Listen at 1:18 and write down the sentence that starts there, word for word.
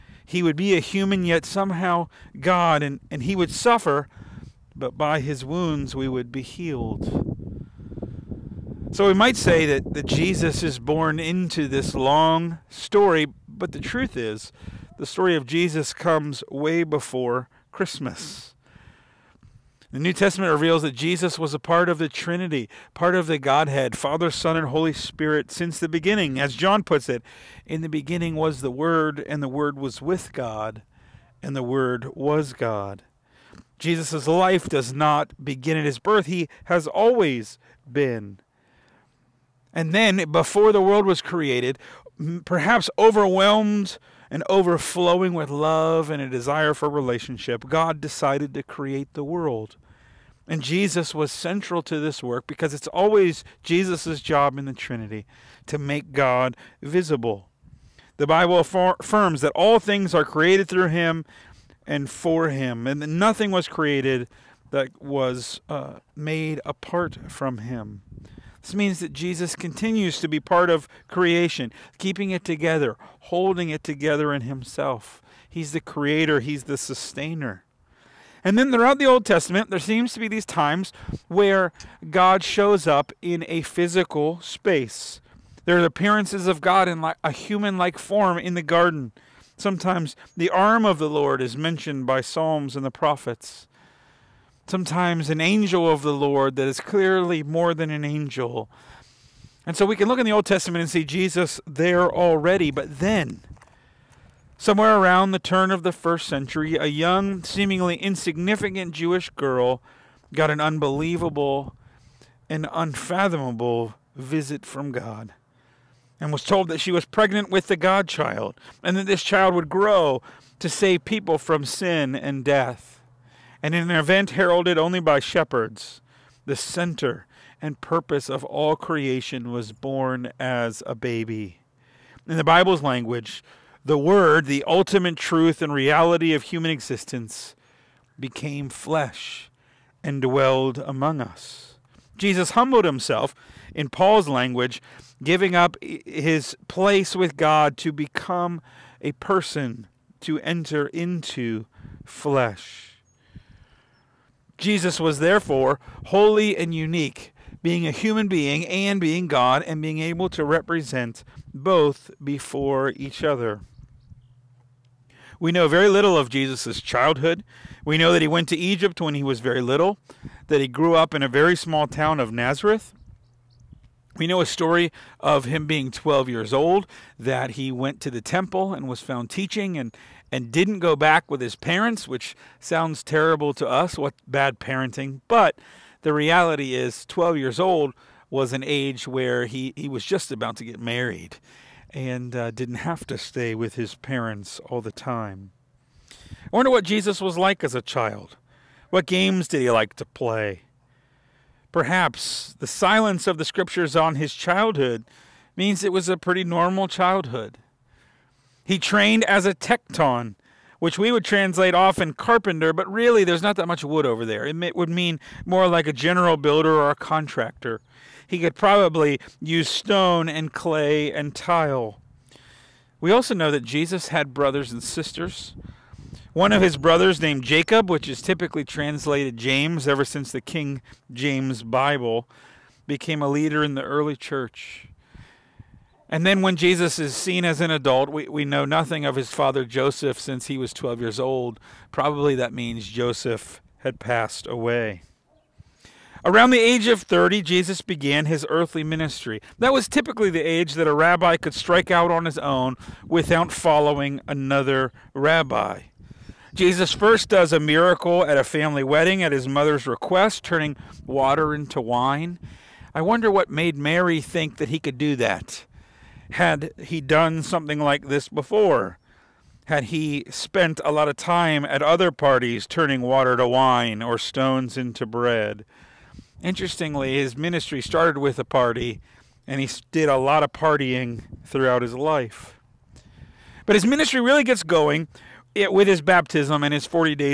And then throughout the Old Testament, there seems to be these times where God shows up in a physical space.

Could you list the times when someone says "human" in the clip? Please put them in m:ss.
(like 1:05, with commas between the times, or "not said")
0:00, 1:27, 2:16, 2:37.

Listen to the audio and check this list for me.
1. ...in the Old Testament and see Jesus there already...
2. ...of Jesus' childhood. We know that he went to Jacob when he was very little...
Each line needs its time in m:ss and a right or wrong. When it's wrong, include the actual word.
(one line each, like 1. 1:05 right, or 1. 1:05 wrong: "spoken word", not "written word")
1. 1:40 right
2. 2:46 wrong: "Egypt", not "Jacob".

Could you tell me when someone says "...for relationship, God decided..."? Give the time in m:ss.
0:46.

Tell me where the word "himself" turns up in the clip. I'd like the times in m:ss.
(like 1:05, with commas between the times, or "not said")
1:14, 2:22.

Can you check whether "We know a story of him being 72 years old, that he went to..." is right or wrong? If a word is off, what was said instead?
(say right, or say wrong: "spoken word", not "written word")
wrong: "12", not "72".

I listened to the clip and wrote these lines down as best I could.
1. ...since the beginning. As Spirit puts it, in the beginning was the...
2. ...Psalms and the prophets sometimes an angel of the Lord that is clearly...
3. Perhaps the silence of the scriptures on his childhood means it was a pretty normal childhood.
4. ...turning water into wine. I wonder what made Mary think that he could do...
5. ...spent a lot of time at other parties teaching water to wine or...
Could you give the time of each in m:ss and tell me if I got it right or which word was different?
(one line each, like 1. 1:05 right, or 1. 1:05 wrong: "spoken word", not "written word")
1. 0:25 wrong: "John", not "Spirit"
2. 1:32 right
3. 3:21 right
4. 4:20 right
5. 4:30 wrong: "turning", not "teaching".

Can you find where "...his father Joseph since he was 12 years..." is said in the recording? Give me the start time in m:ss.
3:59.